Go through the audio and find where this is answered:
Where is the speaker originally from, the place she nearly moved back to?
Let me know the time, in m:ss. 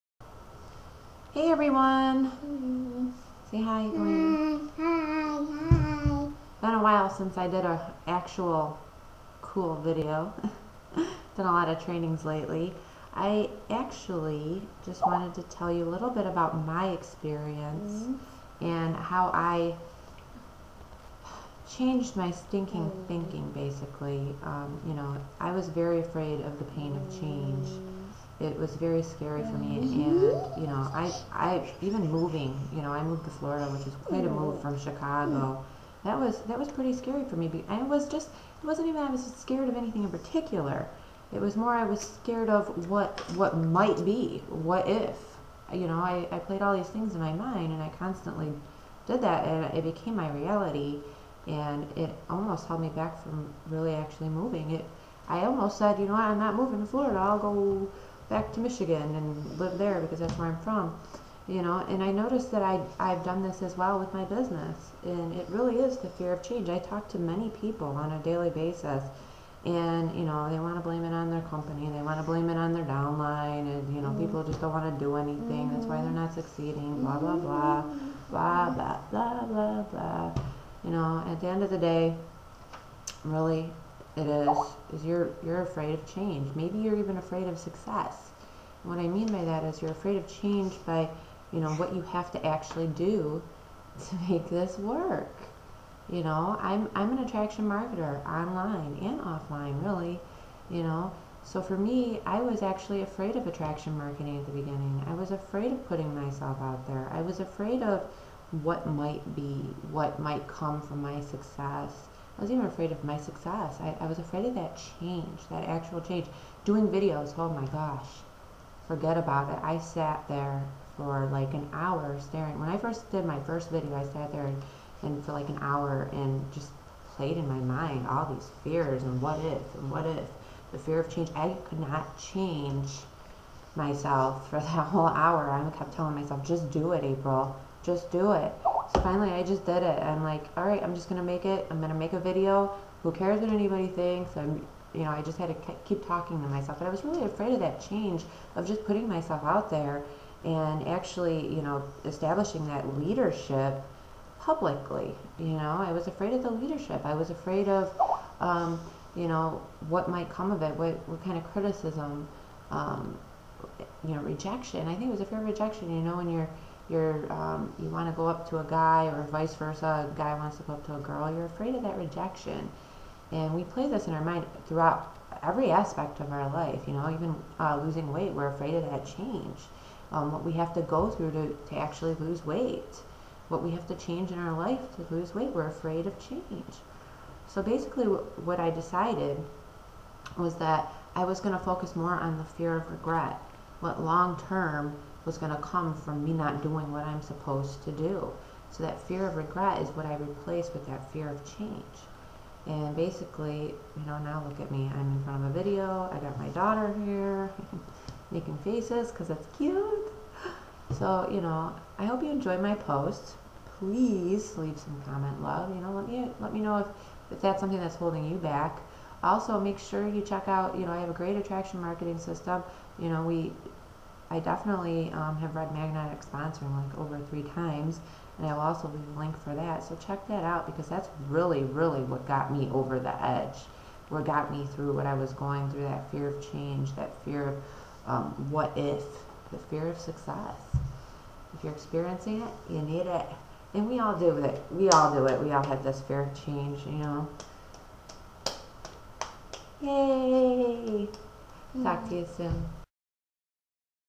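0:58.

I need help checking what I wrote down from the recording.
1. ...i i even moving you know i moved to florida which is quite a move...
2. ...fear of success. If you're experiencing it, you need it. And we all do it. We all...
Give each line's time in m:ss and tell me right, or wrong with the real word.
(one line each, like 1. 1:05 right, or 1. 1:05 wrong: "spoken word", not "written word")
1. 0:30 right
2. 3:59 right.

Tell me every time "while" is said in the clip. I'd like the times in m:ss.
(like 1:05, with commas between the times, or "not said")
0:06.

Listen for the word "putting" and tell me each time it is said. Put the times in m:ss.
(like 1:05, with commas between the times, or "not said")
1:45, 2:28.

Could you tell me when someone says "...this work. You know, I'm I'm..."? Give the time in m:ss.
1:34.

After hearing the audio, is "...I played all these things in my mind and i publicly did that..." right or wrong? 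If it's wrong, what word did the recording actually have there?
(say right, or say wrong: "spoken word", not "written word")
wrong: "constantly", not "publicly".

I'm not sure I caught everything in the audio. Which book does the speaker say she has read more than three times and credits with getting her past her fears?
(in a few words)
Magnetic Sponsoring.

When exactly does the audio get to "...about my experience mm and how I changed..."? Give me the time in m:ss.
0:16.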